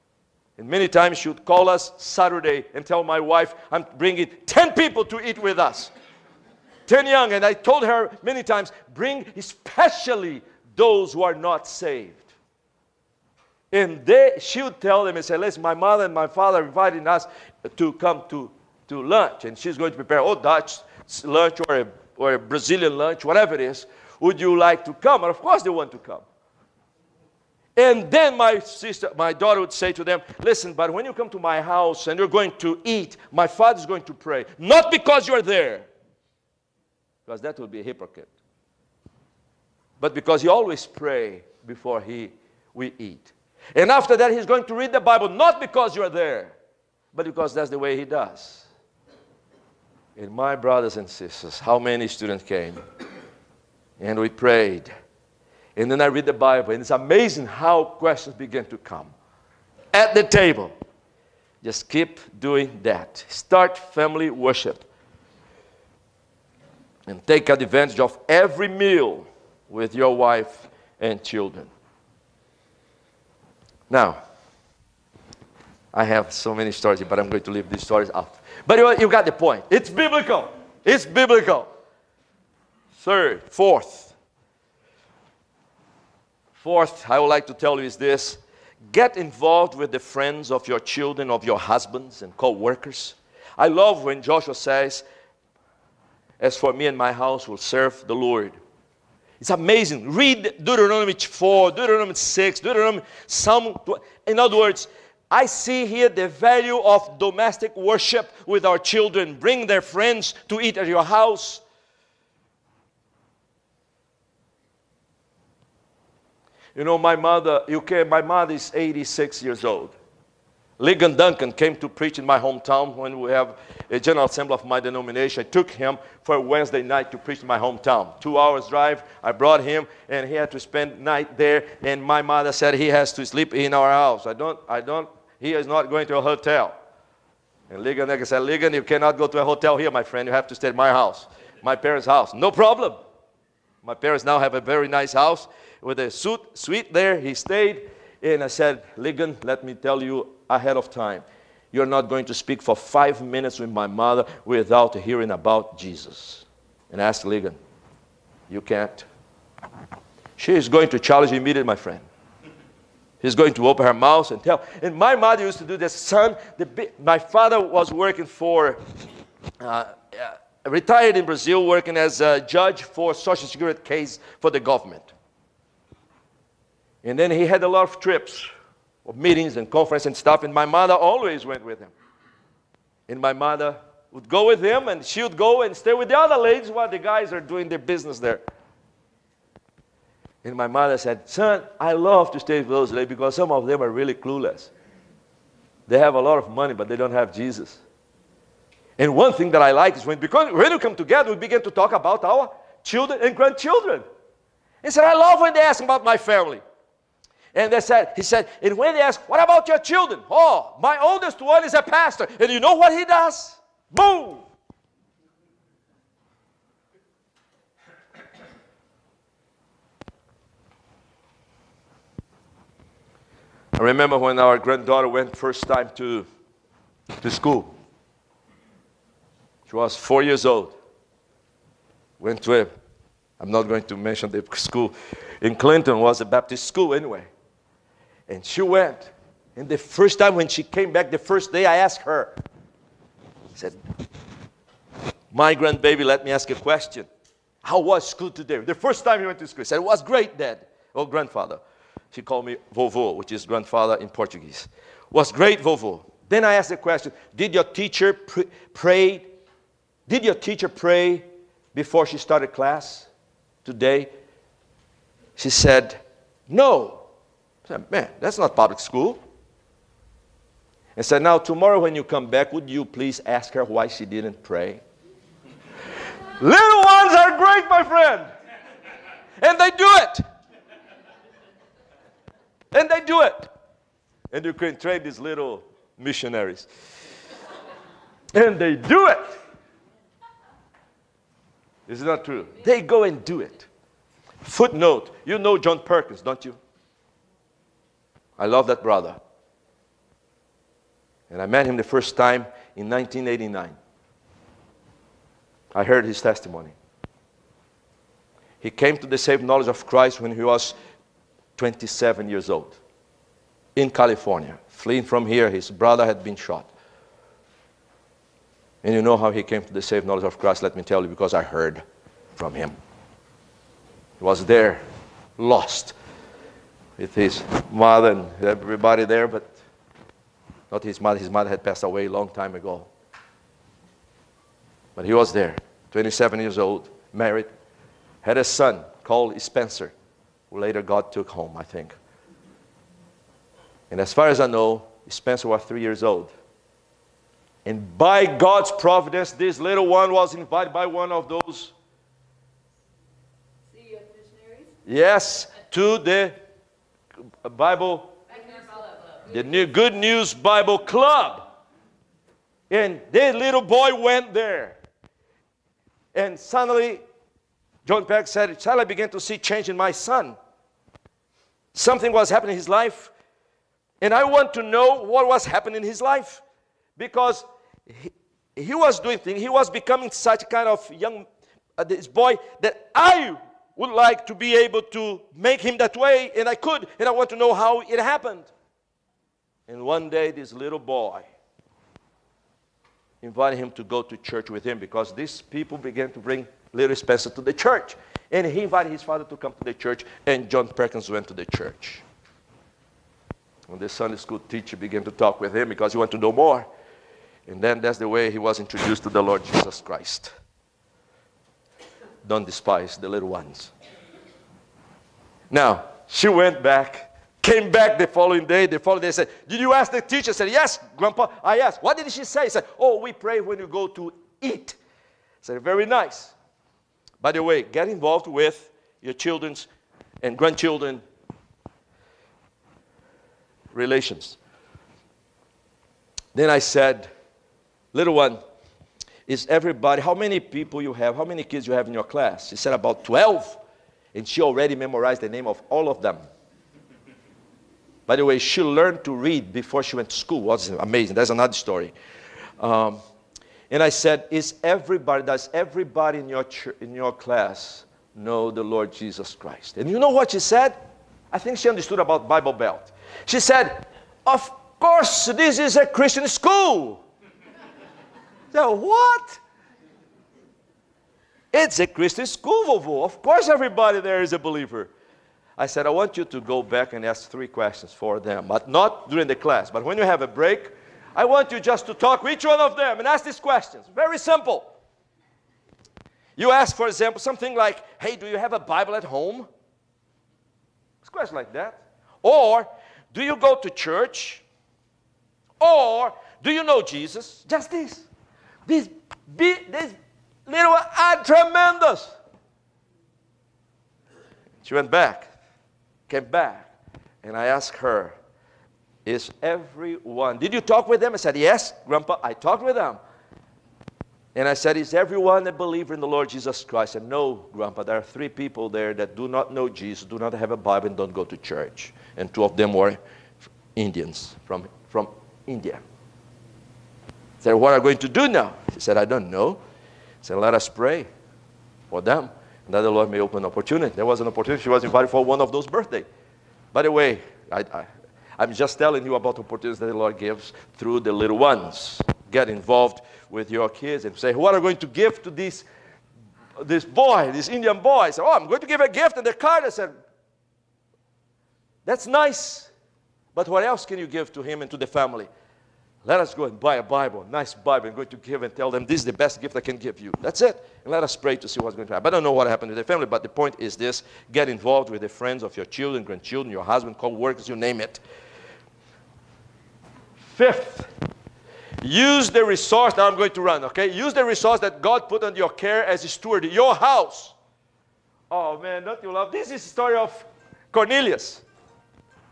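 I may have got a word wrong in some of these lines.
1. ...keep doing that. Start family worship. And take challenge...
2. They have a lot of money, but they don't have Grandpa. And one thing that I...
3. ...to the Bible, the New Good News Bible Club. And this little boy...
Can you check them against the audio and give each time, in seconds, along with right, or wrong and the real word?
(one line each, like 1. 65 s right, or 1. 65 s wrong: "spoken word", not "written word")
1. 61 s wrong: "advantage", not "challenge"
2. 195 s wrong: "Jesus", not "Grandpa"
3. 355 s right.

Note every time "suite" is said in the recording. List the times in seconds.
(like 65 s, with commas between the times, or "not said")
146 s.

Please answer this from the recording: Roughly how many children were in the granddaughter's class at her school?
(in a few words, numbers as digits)
12.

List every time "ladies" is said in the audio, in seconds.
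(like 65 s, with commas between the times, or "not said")
186 s, 192 s.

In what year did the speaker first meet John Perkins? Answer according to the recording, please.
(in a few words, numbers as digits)
1989.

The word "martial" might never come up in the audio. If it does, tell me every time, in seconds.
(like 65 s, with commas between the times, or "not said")
not said.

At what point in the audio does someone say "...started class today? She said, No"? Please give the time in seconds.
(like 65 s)
262 s.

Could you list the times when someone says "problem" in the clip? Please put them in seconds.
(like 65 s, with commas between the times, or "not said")
142 s.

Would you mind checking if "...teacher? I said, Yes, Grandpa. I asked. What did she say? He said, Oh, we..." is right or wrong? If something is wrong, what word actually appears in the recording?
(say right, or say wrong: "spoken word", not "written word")
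right.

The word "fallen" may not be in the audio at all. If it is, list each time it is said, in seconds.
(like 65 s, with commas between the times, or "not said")
not said.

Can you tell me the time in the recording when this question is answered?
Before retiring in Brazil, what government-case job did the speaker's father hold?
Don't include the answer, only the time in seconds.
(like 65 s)
172 s.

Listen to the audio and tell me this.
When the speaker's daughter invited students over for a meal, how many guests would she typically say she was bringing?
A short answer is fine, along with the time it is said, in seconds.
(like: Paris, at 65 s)
10, at 4 s.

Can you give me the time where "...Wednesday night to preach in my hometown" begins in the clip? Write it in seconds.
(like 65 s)
126 s.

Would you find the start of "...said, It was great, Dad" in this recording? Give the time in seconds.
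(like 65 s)
249 s.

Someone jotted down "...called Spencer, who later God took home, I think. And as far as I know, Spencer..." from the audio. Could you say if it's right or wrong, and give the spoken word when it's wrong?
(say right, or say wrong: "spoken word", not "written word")
right.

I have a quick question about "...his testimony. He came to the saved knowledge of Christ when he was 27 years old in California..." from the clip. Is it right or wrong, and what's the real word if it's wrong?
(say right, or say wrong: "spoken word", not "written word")
right.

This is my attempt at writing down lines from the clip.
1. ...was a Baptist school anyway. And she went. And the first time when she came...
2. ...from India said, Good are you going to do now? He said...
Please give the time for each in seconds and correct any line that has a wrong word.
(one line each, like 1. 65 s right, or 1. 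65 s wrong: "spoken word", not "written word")
1. 235 s right
2. 524 s wrong: "What", not "Good".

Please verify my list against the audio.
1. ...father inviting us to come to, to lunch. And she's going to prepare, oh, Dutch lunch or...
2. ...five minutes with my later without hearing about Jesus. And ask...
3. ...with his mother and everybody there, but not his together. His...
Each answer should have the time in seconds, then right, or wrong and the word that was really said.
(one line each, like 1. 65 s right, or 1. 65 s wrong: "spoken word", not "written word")
1. 16 s right
2. 152 s wrong: "mother", not "later"
3. 326 s wrong: "mother", not "together".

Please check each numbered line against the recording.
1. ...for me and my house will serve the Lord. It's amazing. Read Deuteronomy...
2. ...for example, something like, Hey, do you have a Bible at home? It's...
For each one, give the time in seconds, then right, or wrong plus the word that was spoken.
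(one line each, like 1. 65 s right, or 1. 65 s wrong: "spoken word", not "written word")
1. 96 s right
2. 486 s right.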